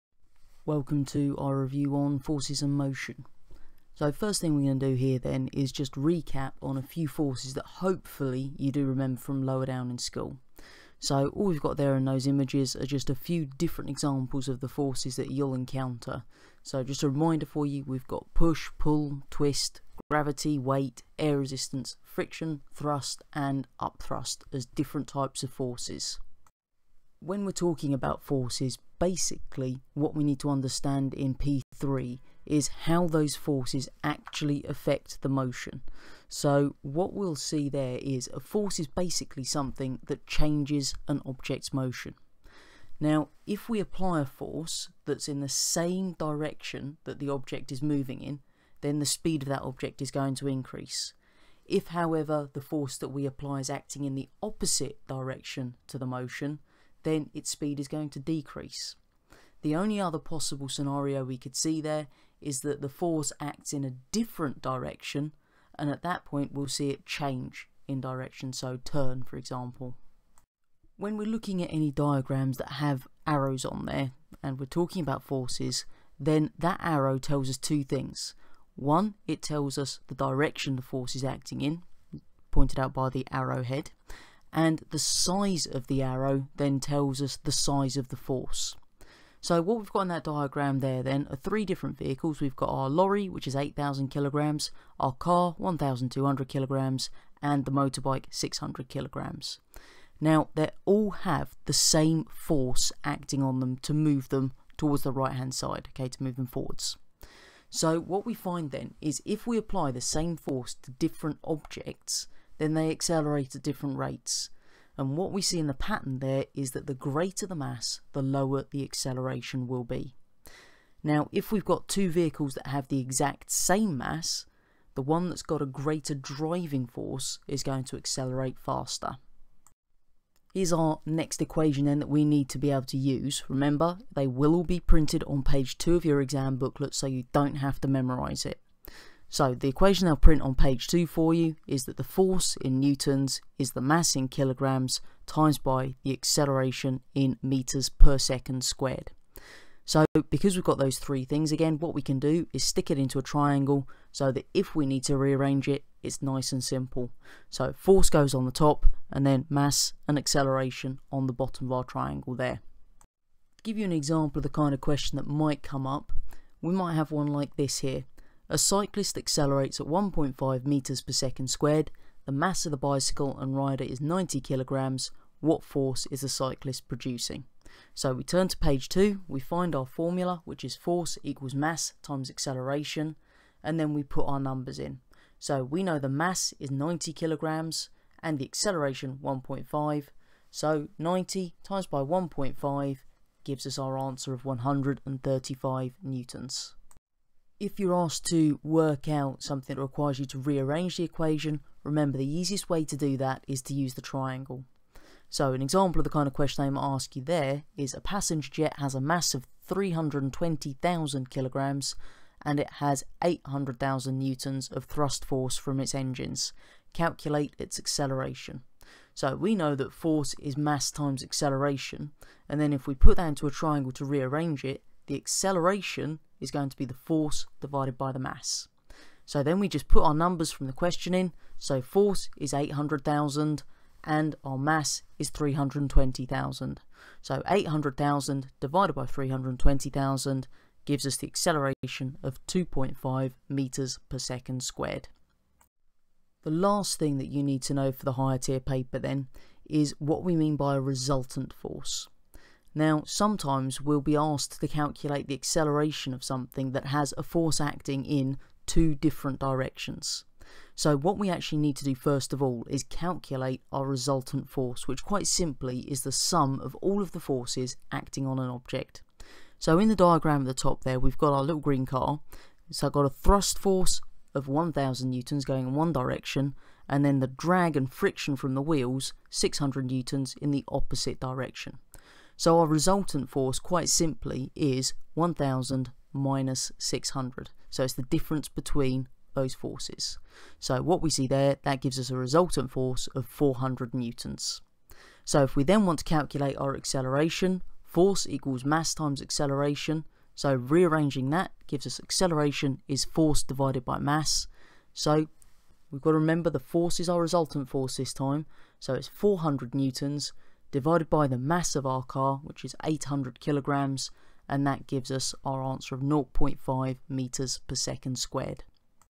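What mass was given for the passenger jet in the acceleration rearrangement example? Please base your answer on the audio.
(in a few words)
320,000 kg.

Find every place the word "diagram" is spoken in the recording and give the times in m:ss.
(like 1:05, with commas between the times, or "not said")
1:11, 1:30, 4:29.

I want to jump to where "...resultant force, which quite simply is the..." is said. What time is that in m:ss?
4:23.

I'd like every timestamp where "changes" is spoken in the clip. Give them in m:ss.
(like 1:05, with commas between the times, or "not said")
0:40, 1:07.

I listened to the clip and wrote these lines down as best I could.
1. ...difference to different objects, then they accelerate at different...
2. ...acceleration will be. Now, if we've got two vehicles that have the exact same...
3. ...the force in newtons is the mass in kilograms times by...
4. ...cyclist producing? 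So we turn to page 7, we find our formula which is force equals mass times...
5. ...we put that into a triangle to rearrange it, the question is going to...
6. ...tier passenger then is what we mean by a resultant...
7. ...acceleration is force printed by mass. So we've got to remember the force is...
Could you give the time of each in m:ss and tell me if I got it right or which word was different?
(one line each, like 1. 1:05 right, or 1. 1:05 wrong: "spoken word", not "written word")
1. 1:50 wrong: "force", not "difference"
2. 1:58 right
3. 2:21 right
4. 2:56 wrong: "2", not "7"
5. 3:42 wrong: "acceleration", not "question"
6. 4:08 wrong: "paper", not "passenger"
7. 5:01 wrong: "divided", not "printed".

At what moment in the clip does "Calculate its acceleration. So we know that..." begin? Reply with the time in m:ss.
3:36.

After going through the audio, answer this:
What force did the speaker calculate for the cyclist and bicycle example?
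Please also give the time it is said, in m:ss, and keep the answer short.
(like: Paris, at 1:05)
135 newtons, at 3:14.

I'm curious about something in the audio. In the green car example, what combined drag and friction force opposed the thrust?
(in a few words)
600 newtons.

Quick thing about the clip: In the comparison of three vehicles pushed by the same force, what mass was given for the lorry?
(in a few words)
8,000 kg.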